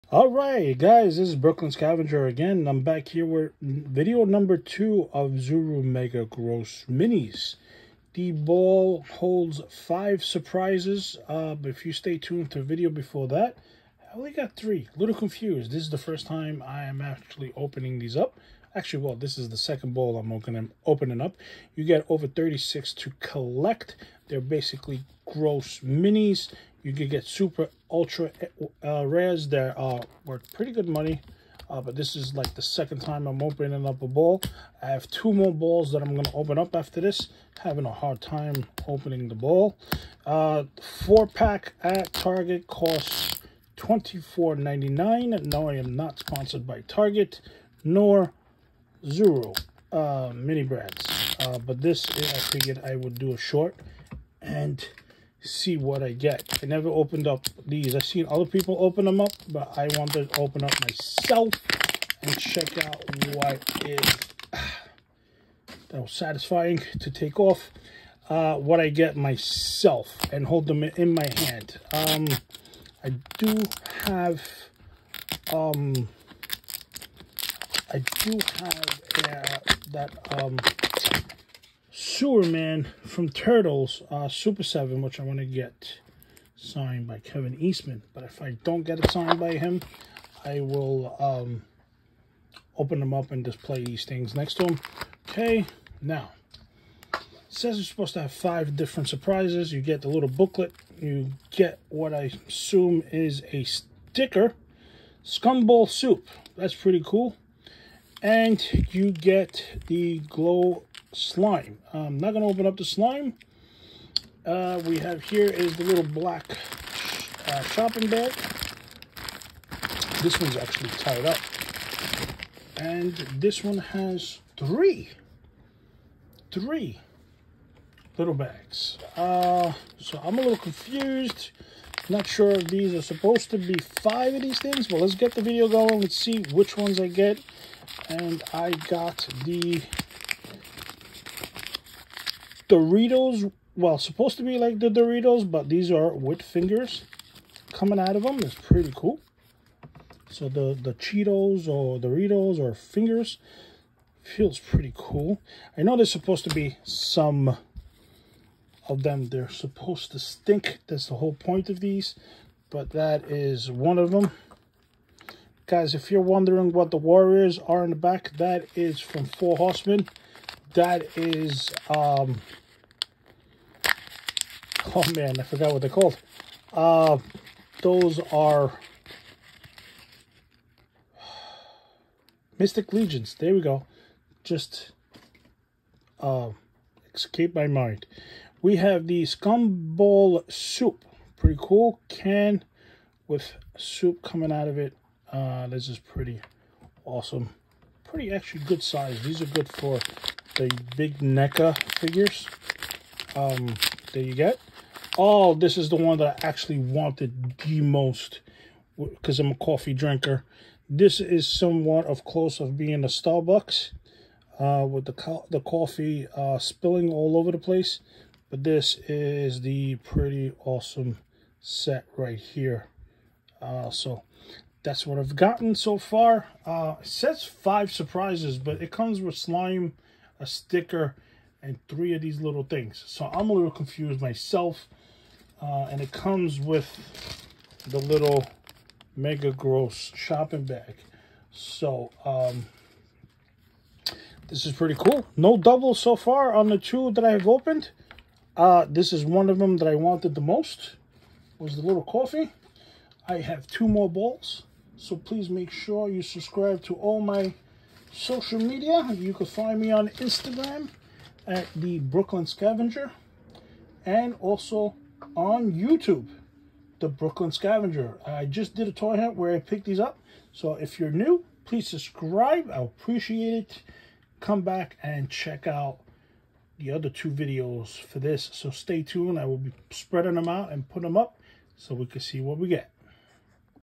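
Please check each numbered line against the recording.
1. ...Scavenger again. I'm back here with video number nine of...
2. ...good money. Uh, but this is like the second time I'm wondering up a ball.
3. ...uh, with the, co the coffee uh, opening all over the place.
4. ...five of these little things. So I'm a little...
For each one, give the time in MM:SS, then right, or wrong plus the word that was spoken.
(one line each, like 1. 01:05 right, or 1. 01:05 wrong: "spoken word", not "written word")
1. 00:01 wrong: "two", not "nine"
2. 00:30 wrong: "opening", not "wondering"
3. 03:34 wrong: "spilling", not "opening"
4. 03:51 wrong: "three", not "five".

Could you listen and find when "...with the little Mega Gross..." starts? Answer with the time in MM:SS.
03:56.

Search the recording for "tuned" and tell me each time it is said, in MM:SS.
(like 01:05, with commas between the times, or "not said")
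00:12, 04:39.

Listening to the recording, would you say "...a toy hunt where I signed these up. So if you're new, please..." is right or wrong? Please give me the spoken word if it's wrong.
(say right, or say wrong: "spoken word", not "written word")
wrong: "picked", not "signed".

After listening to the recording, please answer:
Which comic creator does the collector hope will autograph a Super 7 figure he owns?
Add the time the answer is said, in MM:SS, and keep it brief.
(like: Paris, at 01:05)
Kevin Eastman, at 01:27.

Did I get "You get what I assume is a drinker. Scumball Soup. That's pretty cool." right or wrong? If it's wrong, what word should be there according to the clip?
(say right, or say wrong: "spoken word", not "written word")
wrong: "sticker", not "drinker".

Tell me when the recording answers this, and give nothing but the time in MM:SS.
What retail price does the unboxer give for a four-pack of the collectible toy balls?
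00:43.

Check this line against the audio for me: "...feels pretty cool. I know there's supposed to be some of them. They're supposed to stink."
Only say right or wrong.
right.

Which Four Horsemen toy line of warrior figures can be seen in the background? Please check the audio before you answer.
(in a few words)
Mystic Legions.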